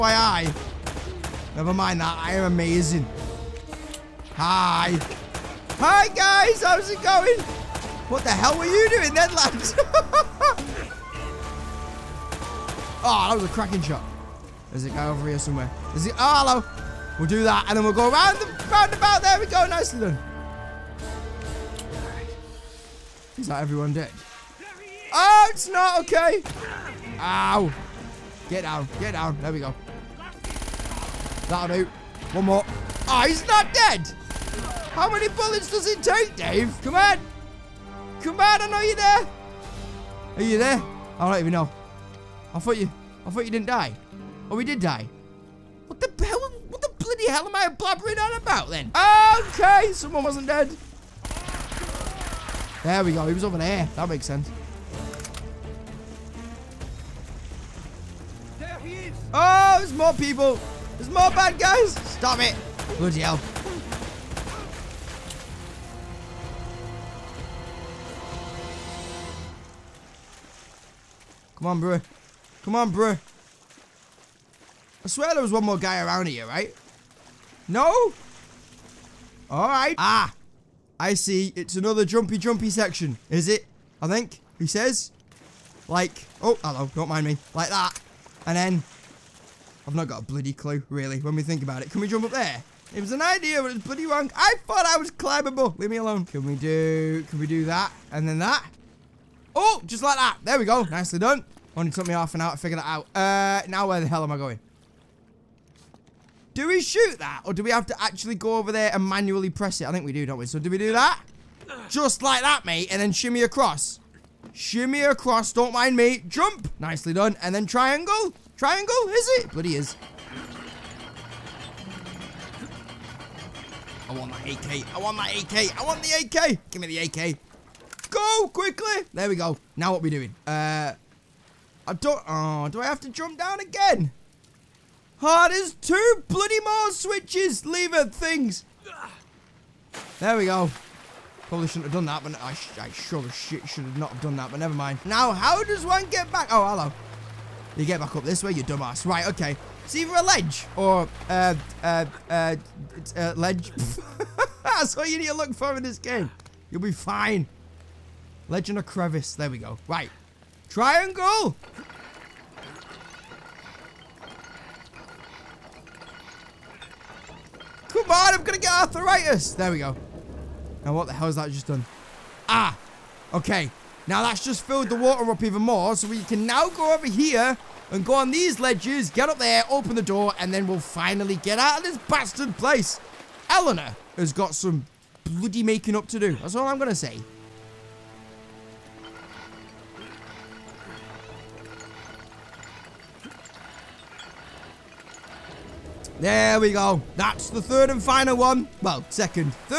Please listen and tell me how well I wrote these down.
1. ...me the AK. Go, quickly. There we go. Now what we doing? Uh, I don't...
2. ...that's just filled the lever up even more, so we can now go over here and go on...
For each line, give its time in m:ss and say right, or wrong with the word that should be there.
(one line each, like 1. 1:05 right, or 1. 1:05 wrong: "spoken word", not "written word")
1. 2:06 right
2. 2:54 wrong: "water", not "lever".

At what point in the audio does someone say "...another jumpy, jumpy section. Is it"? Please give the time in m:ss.
1:21.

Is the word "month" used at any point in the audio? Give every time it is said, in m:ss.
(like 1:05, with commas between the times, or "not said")
not said.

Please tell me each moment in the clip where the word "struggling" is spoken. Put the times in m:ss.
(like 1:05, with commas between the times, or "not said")
not said.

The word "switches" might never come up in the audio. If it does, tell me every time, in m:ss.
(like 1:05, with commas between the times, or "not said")
2:16.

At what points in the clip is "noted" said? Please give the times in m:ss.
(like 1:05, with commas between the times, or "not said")
not said.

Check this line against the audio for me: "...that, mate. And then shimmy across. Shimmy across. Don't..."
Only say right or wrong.
right.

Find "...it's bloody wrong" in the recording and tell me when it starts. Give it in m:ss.
1:33.